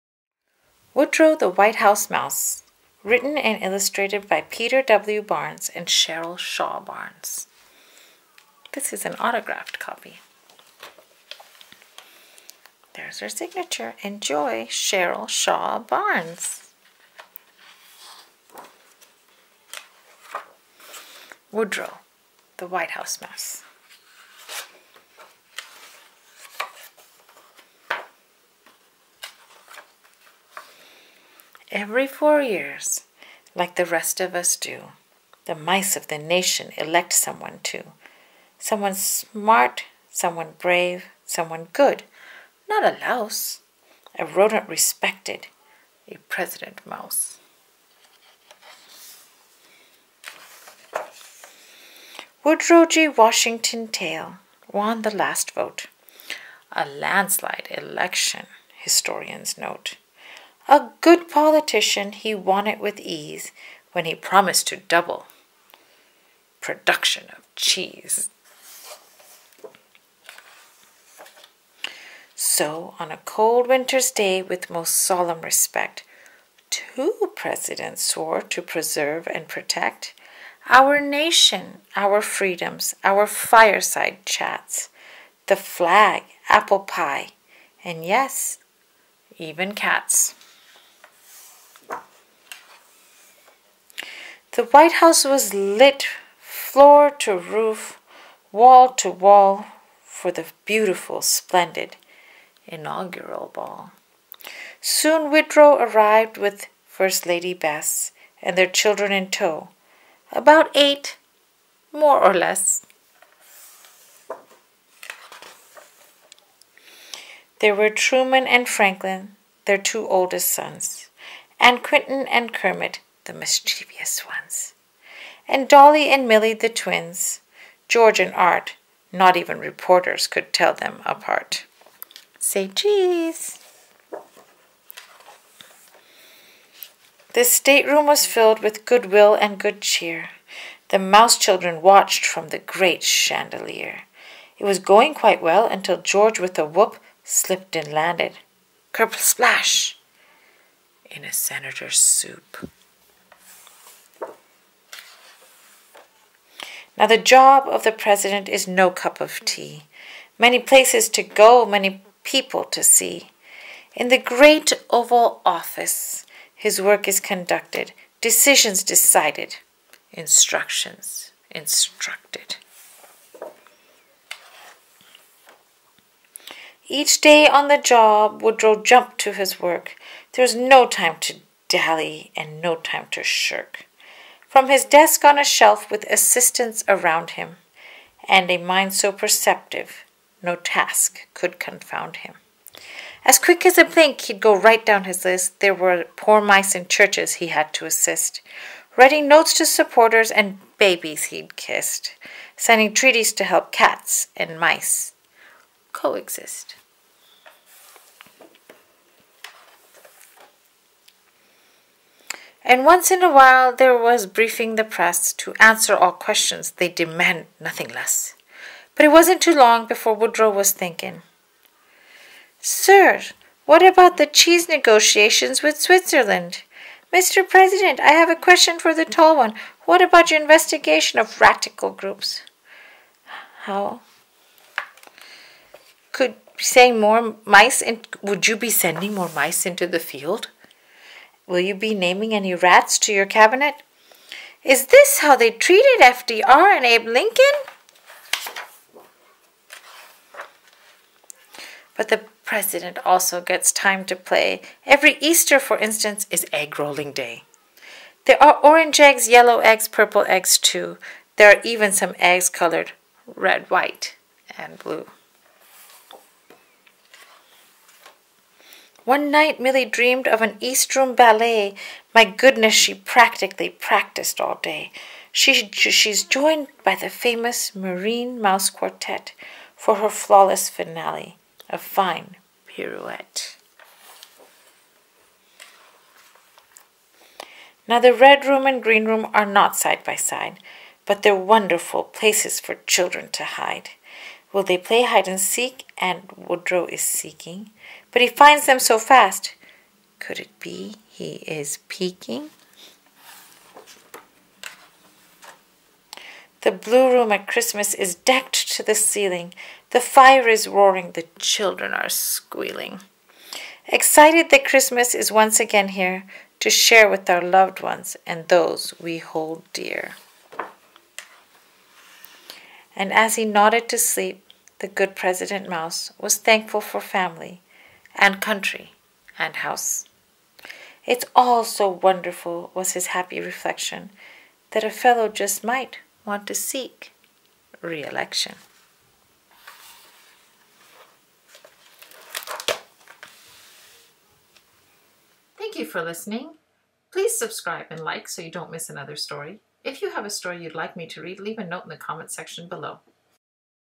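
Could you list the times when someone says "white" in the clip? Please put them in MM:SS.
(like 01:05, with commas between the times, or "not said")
00:01, 00:22, 01:34, 04:23.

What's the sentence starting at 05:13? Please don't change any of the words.
Excited that Christmas is once again here to share with our loved ones and those we hold dear.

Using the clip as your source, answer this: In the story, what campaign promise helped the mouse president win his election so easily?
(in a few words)
double production of cheese.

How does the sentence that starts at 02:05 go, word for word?
And Dolly and Millie, the twins, George and Art, not even reporters could tell them apart.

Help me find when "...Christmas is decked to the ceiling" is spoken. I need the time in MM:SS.
05:07.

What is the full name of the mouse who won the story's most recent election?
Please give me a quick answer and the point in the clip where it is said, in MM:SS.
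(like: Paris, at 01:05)
Woodrow G. Washington Tail, at 00:52.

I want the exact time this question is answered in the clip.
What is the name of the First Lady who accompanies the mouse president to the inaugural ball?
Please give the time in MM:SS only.
01:47.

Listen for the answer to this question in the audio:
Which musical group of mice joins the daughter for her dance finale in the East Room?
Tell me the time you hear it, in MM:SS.
04:37.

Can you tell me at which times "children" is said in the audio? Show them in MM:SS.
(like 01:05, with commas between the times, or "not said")
01:48, 02:21, 04:52, 05:11.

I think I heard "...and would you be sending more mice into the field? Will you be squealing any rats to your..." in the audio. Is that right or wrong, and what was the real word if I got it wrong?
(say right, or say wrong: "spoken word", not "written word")
wrong: "naming", not "squealing".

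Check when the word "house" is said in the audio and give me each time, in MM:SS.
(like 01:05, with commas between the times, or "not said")
00:01, 00:22, 01:34, 05:29.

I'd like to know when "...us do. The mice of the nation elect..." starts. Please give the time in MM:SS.
00:34.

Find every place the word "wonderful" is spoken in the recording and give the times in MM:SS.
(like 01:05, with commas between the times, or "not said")
04:51, 05:31.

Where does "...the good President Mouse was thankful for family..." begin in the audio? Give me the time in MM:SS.
05:24.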